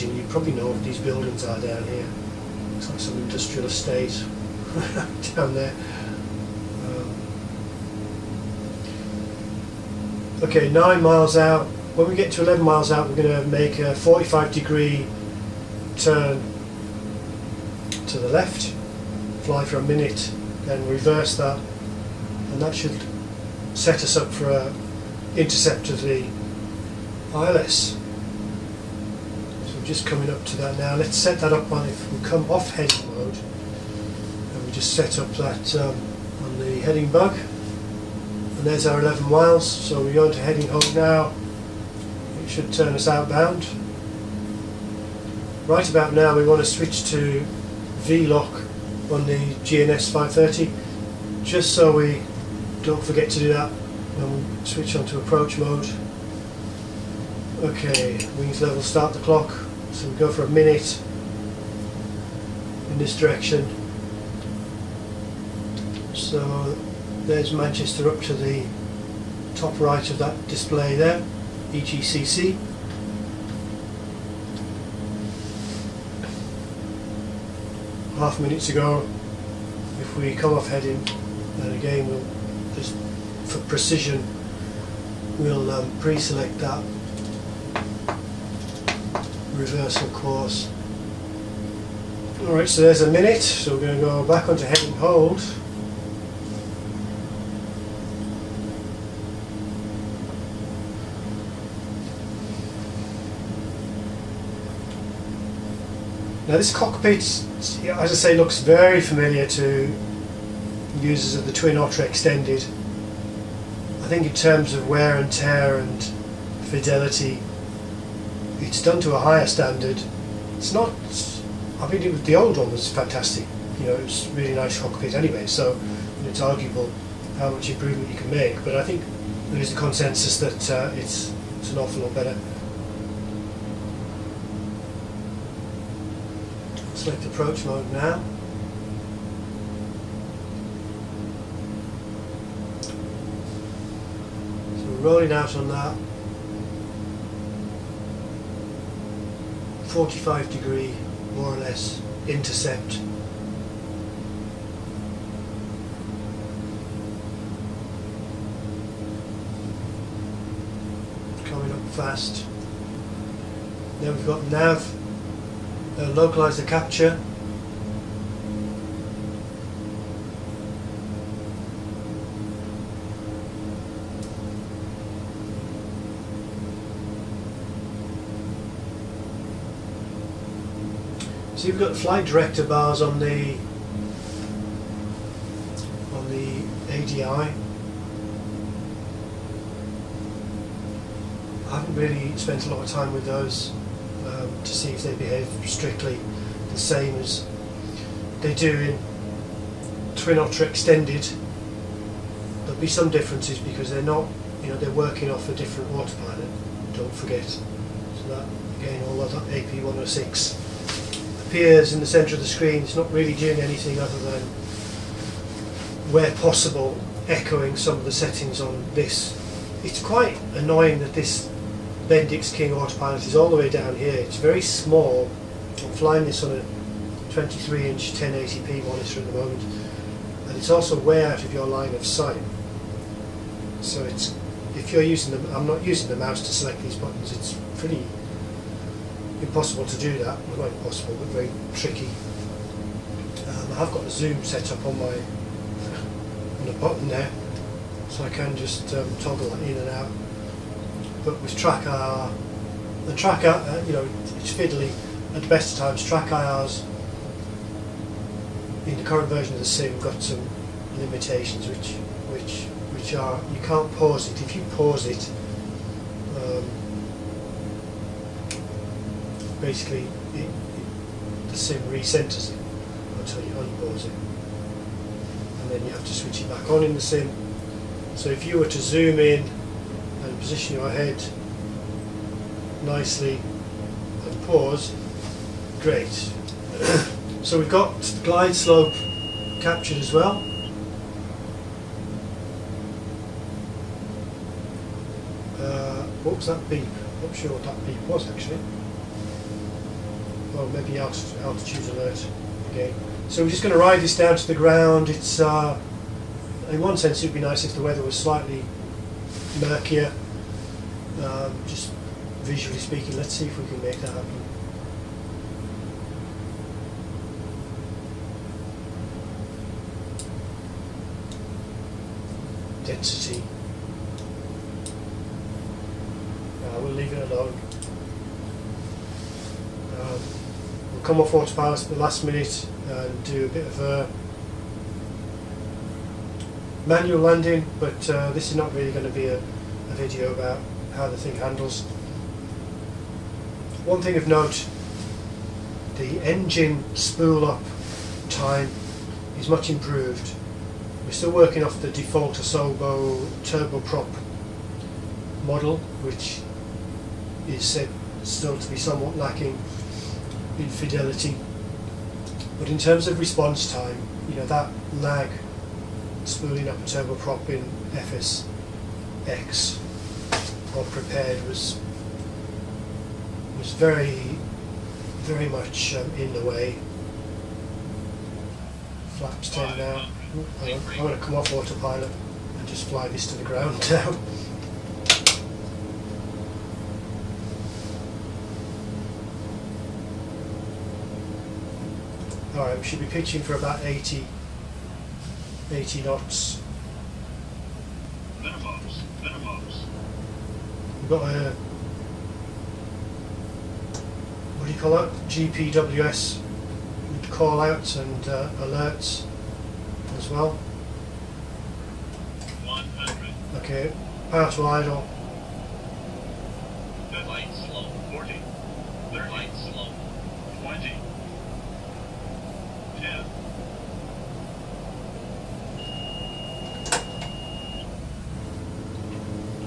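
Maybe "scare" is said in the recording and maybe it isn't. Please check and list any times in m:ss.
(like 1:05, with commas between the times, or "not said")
not said.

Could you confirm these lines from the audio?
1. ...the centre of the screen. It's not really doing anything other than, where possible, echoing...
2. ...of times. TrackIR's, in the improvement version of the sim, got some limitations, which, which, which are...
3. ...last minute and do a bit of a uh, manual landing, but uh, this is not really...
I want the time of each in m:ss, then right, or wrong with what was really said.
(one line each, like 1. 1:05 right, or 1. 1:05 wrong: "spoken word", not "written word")
1. 3:32 right
2. 4:15 wrong: "current", not "improvement"
3. 5:32 right.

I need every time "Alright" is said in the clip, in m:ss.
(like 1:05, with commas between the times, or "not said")
1:32, 6:32.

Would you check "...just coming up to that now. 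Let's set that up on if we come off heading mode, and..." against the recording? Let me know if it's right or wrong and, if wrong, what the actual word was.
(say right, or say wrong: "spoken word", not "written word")
right.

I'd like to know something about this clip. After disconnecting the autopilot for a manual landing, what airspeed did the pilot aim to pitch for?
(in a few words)
80 knots.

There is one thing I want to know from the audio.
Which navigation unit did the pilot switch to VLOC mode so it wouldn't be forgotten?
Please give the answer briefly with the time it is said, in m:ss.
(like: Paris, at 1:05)
GNS 530, at 0:49.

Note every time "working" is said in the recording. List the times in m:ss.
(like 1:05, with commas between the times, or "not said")
3:24, 5:51.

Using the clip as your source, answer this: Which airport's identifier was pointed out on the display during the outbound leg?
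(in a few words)
EGCC.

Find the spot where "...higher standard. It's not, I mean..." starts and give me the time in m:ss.
1:59.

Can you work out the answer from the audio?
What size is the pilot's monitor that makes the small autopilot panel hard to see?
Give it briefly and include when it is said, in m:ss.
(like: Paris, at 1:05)
23 inch, at 3:47.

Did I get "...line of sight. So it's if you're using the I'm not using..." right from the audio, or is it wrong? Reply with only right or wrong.
right.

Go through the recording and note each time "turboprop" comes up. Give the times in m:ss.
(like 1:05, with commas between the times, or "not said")
5:53, 6:06.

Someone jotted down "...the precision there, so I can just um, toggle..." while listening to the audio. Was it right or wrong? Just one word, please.
wrong.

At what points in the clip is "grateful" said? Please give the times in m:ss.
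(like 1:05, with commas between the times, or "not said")
not said.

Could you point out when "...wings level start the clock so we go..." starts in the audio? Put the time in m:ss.
0:58.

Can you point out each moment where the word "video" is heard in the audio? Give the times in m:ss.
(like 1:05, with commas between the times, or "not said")
5:39.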